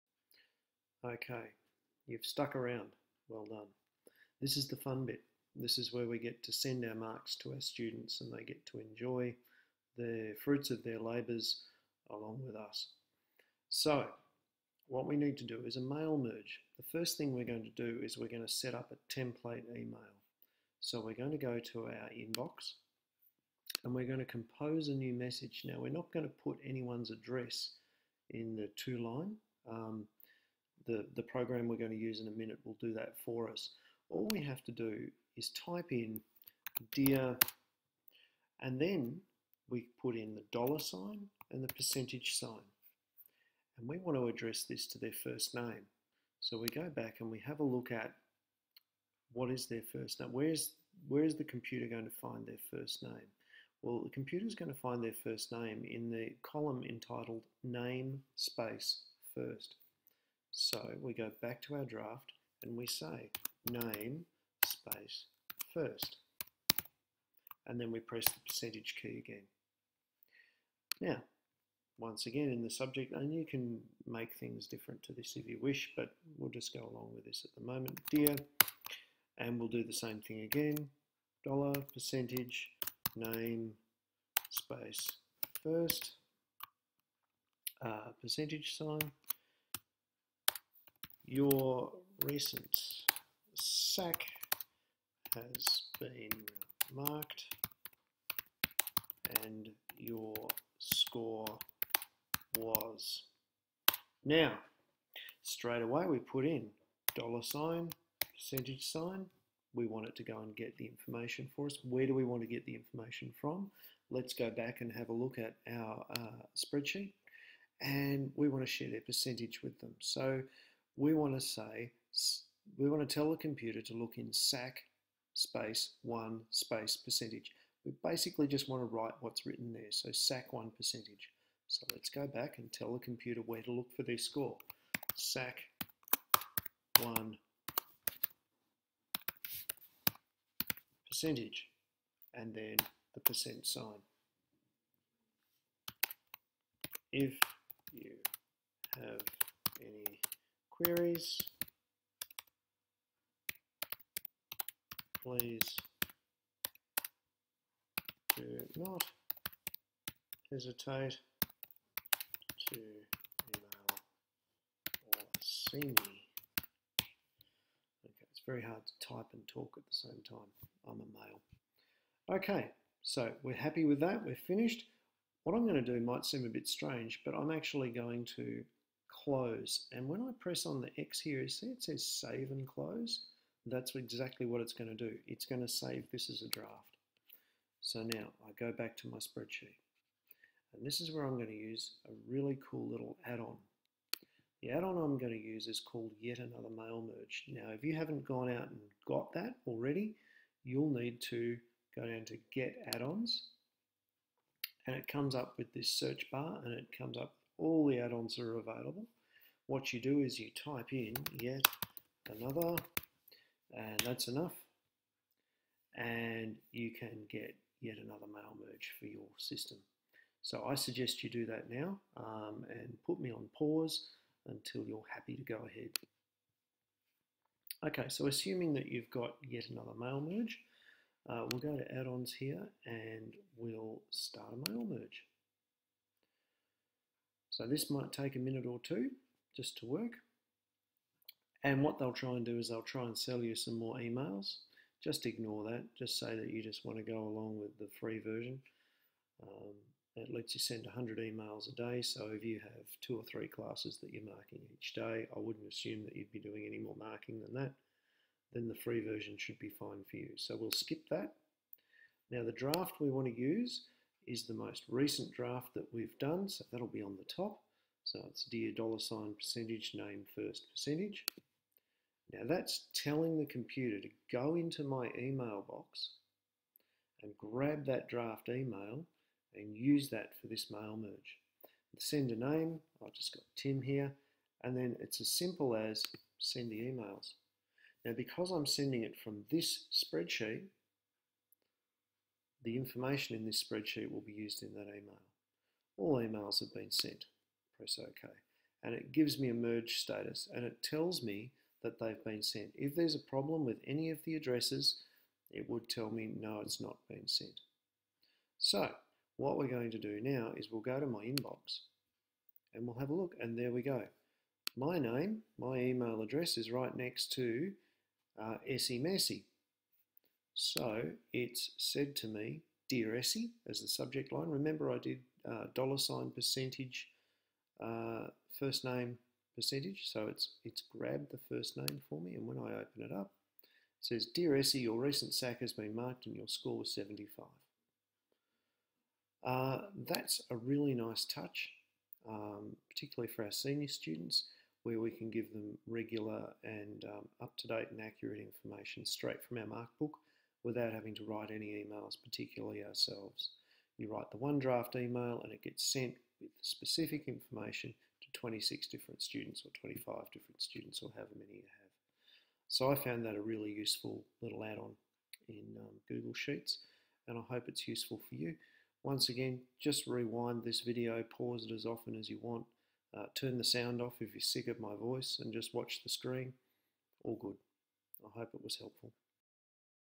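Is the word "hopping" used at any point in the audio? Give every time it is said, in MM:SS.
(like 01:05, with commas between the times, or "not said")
not said.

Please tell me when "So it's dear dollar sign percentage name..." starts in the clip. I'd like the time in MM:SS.
04:28.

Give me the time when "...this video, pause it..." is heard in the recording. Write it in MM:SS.
06:10.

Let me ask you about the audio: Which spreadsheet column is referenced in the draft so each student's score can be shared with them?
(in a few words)
SAC 1 percentage.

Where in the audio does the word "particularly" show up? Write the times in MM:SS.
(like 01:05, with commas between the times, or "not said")
05:42, 05:52.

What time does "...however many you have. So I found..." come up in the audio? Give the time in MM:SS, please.
06:01.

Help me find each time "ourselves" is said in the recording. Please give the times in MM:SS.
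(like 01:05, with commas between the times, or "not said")
05:52.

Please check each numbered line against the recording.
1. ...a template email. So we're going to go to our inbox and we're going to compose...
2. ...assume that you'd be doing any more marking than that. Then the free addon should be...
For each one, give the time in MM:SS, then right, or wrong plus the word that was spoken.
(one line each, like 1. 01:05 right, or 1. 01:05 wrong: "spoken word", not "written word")
1. 00:18 right
2. 04:15 wrong: "version", not "addon".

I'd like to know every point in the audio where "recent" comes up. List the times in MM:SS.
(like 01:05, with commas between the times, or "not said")
01:32, 04:24, 05:35.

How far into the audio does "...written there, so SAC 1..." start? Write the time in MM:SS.
02:09.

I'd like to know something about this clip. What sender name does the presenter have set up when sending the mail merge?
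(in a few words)
Tim.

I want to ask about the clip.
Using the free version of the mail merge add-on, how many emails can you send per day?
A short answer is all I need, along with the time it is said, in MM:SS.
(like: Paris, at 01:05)
100, at 04:10.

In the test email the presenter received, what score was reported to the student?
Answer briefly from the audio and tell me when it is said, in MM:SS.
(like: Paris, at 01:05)
75, at 05:36.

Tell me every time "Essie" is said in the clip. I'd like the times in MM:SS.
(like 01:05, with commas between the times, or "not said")
05:23, 05:34.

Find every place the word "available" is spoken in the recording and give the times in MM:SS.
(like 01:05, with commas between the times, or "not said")
03:28.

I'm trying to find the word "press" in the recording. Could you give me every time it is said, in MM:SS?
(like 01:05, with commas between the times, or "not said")
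01:07, 03:00, 04:57.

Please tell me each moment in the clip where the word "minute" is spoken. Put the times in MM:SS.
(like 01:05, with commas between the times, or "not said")
00:32, 03:58.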